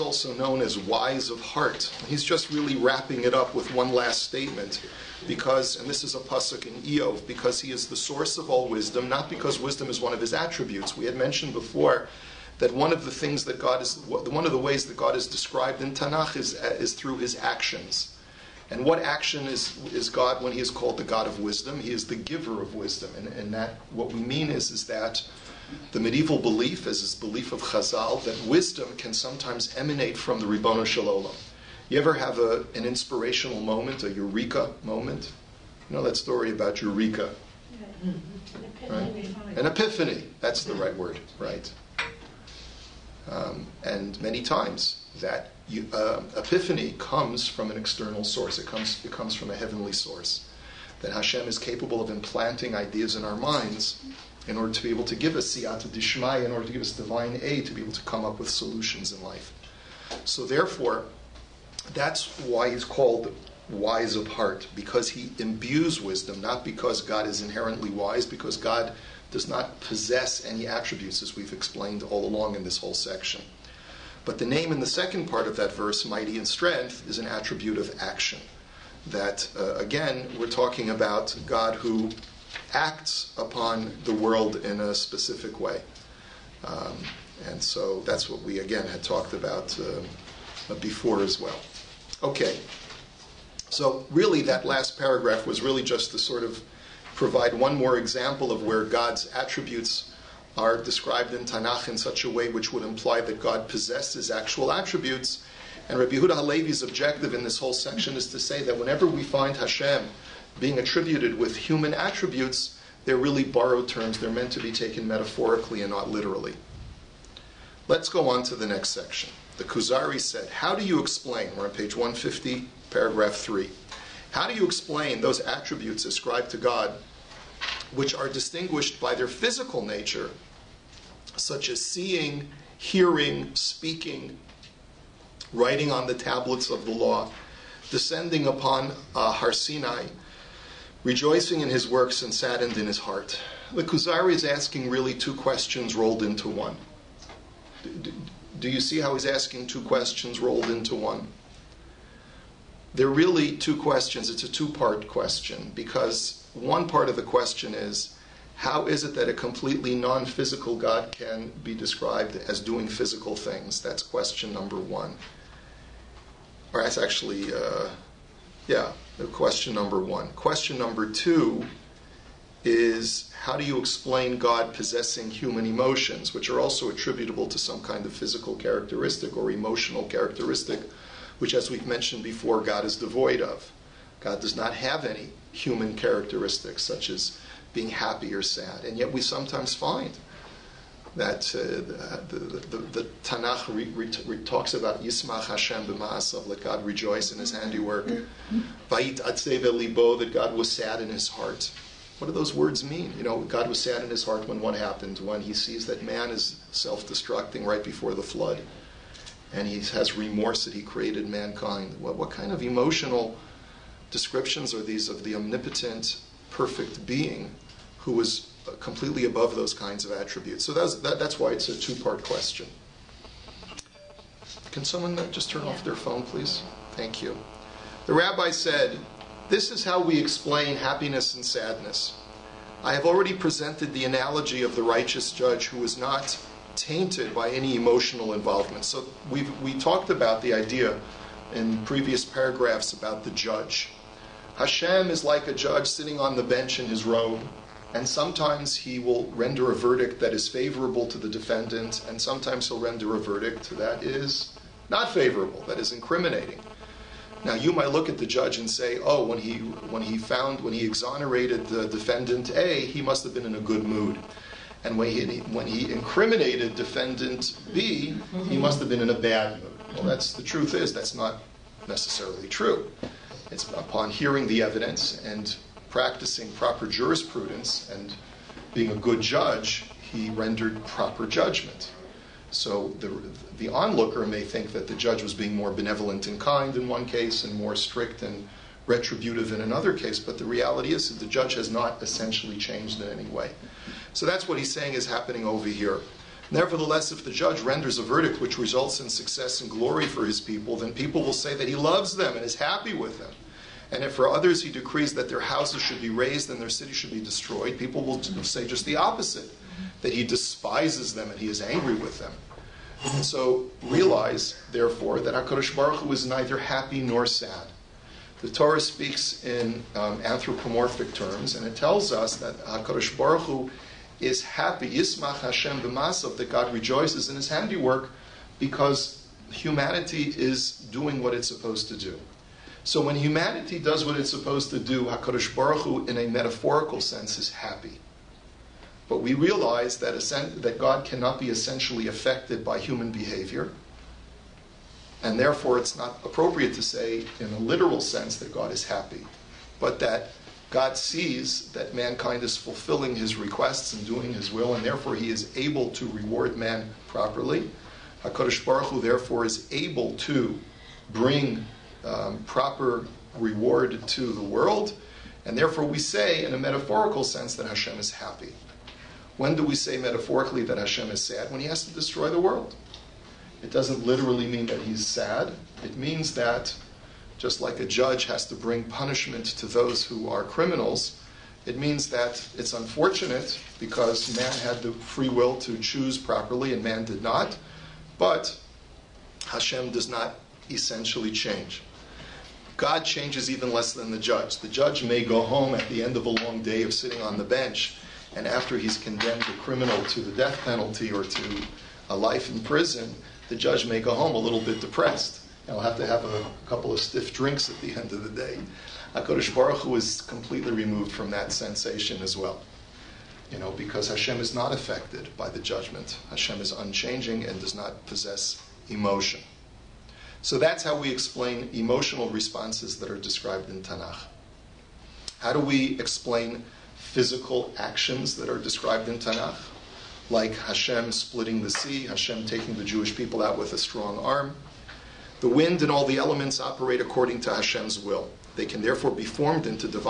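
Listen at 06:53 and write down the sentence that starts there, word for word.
You know, because Hashem is not affected by the judgment.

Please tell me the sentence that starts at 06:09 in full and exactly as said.
When do we say metaphorically that Hashem is sad?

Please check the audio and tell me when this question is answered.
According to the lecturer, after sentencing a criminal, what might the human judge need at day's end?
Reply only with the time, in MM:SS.
06:46.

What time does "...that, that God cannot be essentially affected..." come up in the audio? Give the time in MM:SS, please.
05:39.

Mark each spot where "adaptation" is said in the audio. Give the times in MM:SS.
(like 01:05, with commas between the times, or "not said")
not said.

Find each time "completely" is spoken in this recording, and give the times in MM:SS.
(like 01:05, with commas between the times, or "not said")
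02:39, 03:38, 06:50.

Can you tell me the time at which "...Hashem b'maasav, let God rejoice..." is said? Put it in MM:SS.
03:15.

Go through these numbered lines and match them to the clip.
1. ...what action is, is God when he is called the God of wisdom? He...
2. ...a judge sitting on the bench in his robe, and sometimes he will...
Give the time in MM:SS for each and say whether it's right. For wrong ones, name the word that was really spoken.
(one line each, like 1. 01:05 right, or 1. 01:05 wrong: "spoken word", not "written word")
1. 00:18 right
2. 04:05 right.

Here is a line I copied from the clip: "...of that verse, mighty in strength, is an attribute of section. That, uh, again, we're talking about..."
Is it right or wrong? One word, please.
wrong.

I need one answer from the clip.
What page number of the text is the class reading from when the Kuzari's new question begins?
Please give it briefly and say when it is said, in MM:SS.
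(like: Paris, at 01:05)
150, at 02:01.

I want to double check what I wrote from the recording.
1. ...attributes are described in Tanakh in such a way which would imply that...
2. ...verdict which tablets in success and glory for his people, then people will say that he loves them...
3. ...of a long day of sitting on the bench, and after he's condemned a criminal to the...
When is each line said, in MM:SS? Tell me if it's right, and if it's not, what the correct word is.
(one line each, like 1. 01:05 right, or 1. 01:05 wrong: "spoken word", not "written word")
1. 01:39 right
2. 04:58 wrong: "results", not "tablets"
3. 06:36 right.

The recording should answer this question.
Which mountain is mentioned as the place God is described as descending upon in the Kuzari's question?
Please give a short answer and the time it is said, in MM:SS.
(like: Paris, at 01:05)
Har Sinai, at 02:19.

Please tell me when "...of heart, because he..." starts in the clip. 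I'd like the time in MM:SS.
01:04.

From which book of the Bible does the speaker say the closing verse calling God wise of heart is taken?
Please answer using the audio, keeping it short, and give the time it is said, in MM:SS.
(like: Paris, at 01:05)
Iyov, at 00:06.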